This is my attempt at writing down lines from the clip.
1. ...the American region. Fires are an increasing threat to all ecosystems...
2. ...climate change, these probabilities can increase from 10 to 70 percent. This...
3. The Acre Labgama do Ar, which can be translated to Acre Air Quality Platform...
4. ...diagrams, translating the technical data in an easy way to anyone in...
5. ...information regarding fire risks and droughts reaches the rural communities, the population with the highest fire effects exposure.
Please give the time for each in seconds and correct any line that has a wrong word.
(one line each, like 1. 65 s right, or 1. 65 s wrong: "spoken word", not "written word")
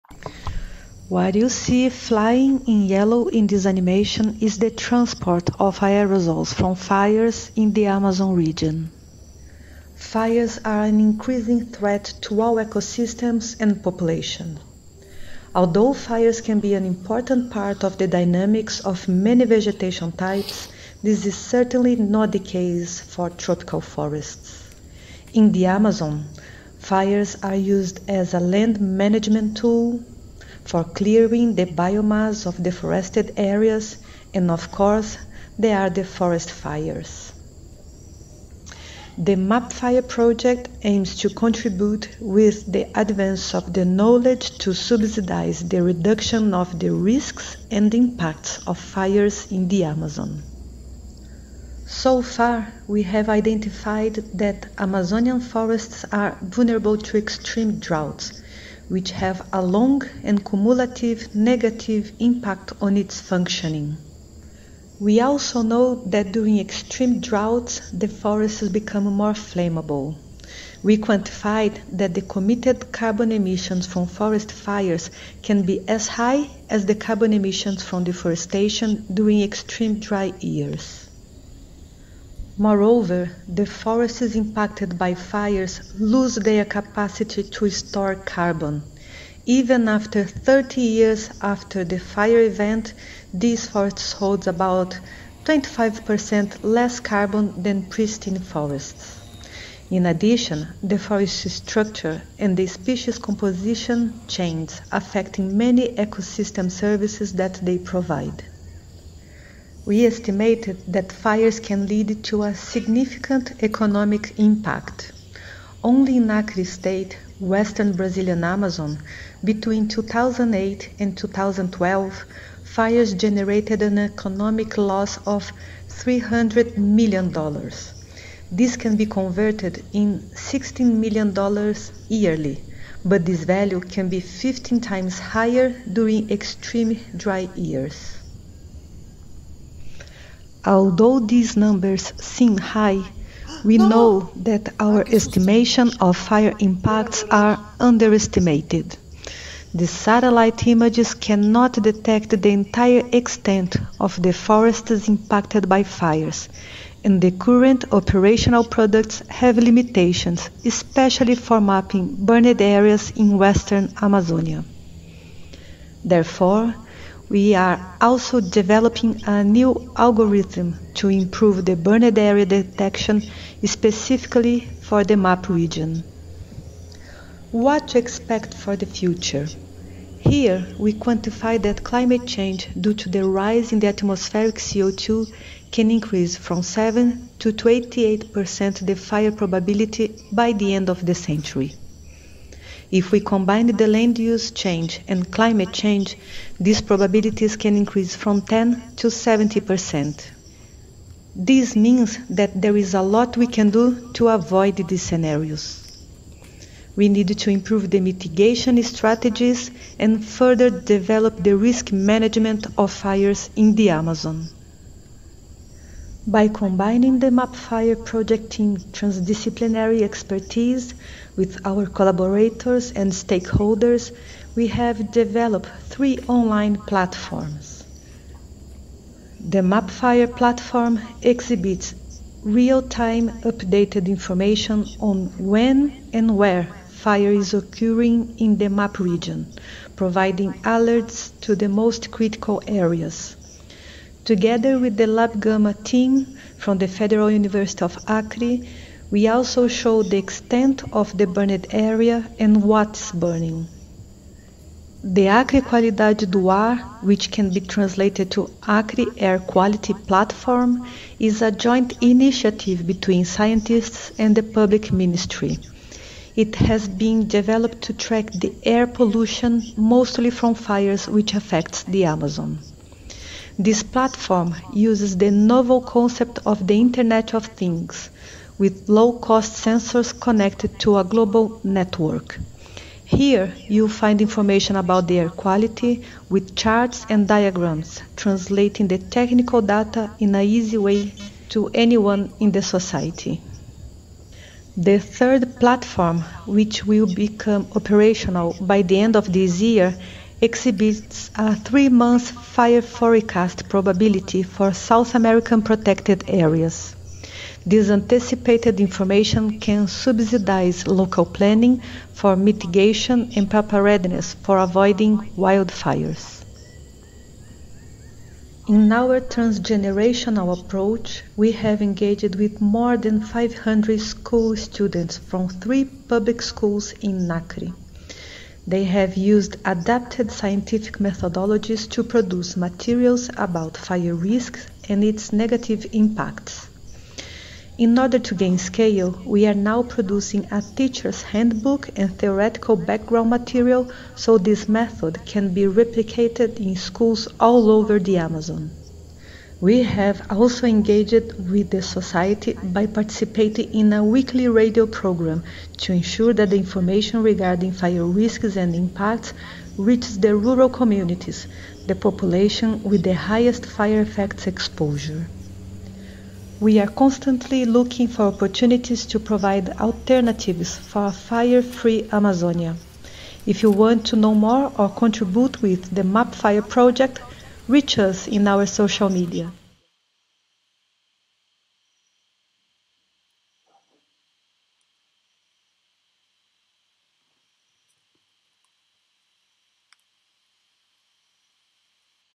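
1. 7 s wrong: "Amazon", not "American"
2. 195 s right
3. 255 s wrong: "Qualidade", not "Labgama"
4. 287 s right
5. 356 s wrong: "impacts", not "droughts".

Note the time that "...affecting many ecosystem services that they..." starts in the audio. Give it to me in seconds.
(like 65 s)
104 s.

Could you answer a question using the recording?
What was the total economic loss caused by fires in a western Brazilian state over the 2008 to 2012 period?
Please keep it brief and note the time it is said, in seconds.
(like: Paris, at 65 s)
$300 million, at 125 s.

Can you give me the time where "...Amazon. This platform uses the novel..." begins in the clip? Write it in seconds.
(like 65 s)
272 s.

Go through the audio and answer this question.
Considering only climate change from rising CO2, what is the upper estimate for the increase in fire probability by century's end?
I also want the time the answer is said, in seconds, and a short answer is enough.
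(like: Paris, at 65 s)
28%, at 187 s.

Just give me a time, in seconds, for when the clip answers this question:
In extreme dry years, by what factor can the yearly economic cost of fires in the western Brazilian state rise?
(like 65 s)
134 s.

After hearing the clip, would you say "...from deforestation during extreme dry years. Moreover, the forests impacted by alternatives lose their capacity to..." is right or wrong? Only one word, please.
wrong.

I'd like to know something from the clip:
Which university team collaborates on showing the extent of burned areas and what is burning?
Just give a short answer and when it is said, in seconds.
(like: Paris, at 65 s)
Labgama, at 245 s.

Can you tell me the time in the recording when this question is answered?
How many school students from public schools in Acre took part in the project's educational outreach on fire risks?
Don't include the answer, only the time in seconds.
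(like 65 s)
323 s.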